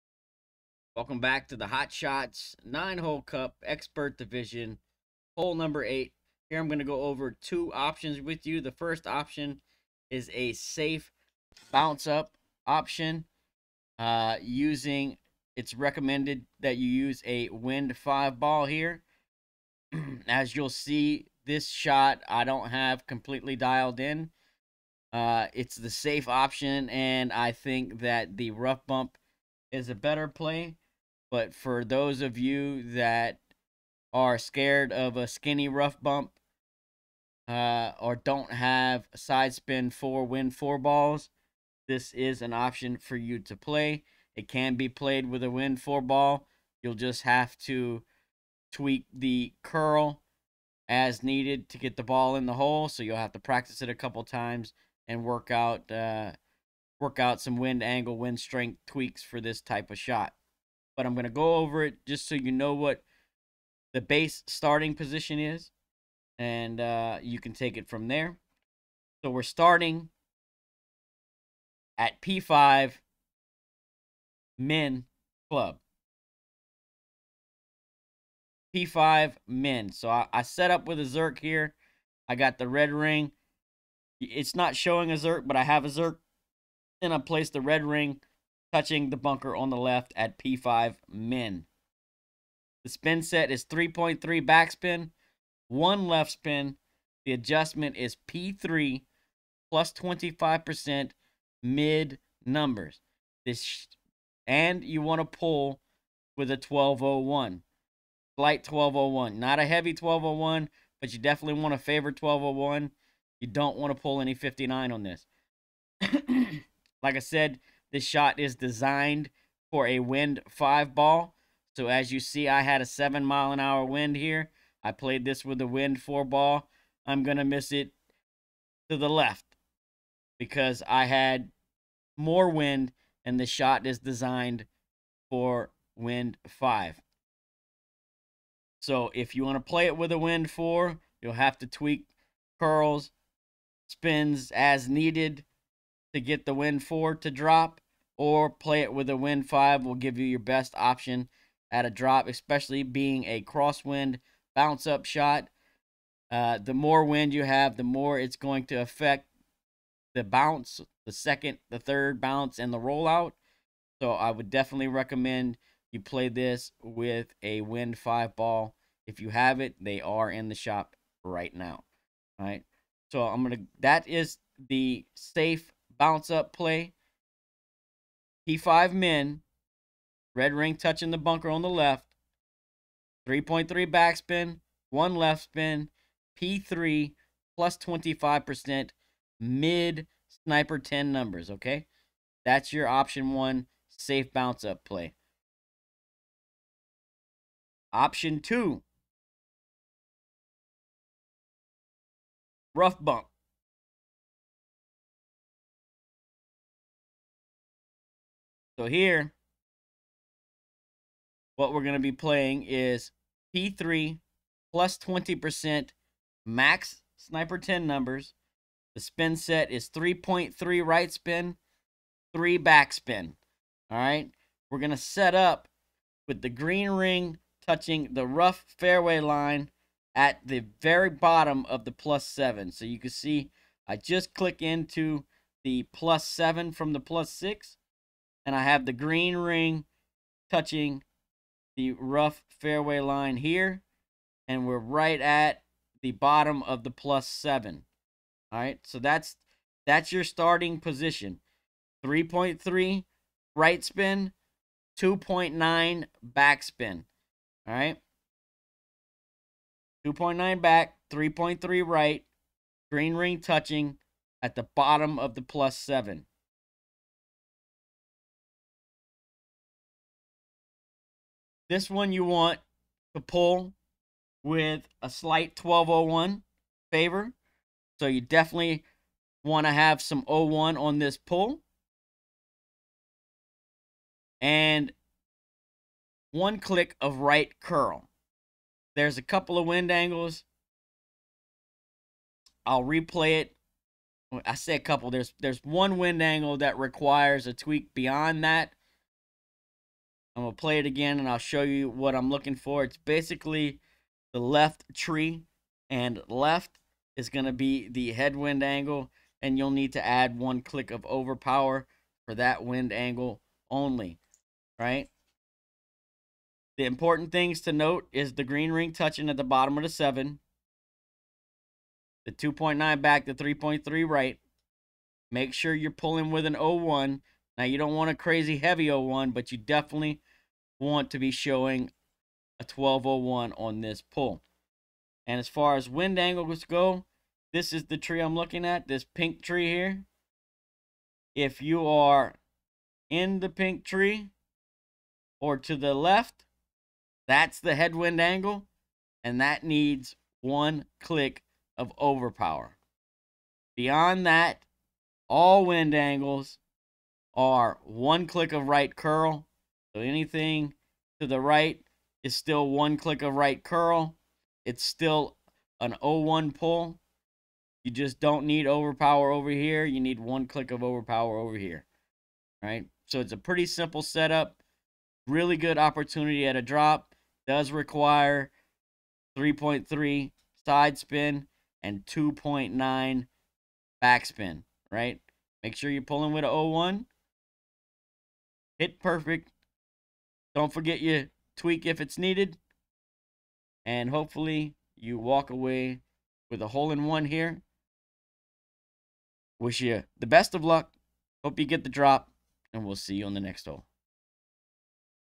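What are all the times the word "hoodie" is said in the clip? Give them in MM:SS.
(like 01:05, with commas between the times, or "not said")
not said.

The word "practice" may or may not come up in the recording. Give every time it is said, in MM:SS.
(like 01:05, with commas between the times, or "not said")
00:53.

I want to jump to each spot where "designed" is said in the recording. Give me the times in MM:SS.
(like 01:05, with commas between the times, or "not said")
01:58, 02:13.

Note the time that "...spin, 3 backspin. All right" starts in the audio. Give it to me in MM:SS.
03:41.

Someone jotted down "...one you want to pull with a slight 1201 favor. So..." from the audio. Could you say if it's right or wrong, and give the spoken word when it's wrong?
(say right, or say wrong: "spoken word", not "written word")
right.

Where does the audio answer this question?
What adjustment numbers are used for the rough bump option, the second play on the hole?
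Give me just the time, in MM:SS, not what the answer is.
03:33.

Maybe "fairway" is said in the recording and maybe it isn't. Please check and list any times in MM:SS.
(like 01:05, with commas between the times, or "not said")
03:48, 04:02.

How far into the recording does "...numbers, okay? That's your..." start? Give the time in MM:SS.
03:11.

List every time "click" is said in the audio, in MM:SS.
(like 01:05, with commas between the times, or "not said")
03:54, 04:46, 05:10, 05:50, 05:58, 06:02, 06:10.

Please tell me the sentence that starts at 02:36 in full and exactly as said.
Uh, the more wind you have, the more it's going to affect the bounce, the second, the third bounce, and the rollout.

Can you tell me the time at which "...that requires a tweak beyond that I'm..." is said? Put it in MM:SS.
04:56.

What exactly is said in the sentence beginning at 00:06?
Here I'm going to go over two options with you.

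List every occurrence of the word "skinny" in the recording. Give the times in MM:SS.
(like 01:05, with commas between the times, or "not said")
00:35.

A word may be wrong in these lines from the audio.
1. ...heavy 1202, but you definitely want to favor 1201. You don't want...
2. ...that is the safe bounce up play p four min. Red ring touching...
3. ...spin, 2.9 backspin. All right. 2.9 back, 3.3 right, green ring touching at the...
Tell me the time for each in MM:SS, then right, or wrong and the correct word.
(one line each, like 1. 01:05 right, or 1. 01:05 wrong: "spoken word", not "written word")
1. 01:49 wrong: "1201", not "1202"
2. 02:53 wrong: "five", not "four"
3. 04:13 right.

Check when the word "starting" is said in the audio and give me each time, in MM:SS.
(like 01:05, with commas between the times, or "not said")
01:04, 01:09, 04:10.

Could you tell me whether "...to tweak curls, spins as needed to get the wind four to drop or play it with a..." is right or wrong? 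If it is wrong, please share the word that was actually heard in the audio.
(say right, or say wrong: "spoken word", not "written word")
right.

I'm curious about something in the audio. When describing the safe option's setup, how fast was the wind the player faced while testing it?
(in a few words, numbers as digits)
7 miles per hour.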